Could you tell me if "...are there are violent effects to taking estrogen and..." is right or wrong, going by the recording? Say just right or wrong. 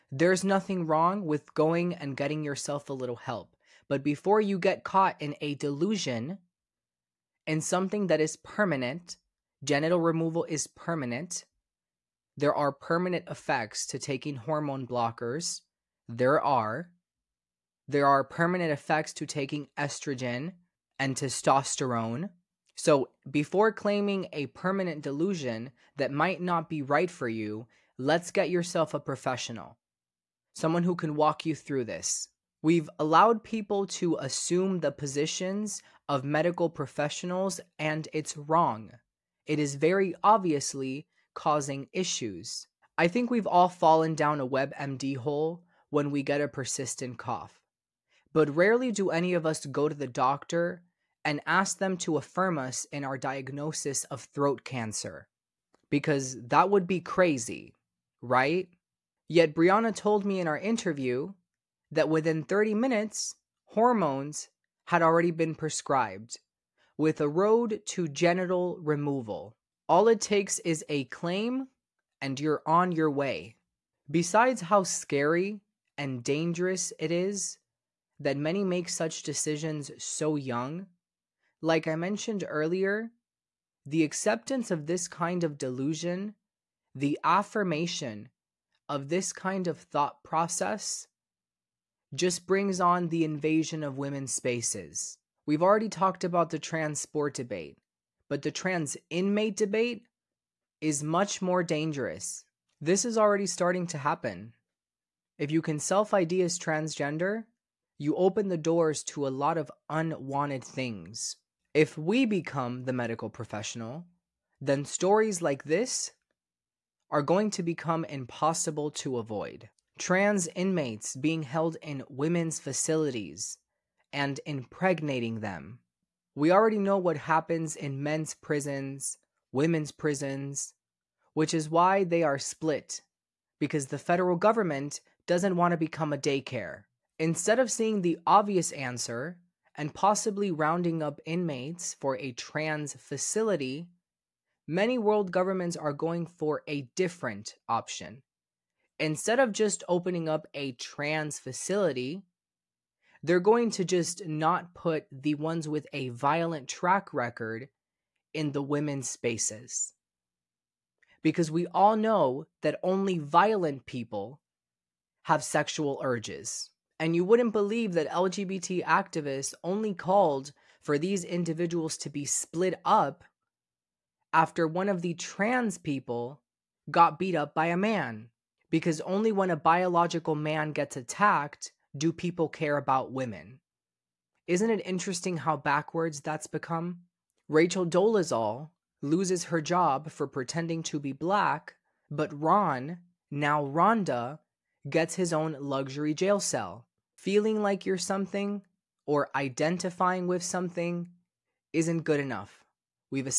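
wrong.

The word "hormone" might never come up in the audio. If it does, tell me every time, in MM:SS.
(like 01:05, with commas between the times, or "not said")
00:14, 01:03.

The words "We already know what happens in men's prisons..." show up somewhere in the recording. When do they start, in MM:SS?
02:06.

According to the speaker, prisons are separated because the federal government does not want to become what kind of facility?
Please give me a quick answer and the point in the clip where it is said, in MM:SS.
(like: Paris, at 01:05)
Daycare, at 02:16.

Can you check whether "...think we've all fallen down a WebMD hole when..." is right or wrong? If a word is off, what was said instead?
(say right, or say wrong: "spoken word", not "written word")
right.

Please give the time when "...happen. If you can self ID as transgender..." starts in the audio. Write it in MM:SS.
01:43.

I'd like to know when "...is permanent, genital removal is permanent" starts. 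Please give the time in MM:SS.
00:08.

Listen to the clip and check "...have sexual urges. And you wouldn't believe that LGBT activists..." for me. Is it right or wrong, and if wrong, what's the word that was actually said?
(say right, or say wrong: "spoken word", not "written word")
right.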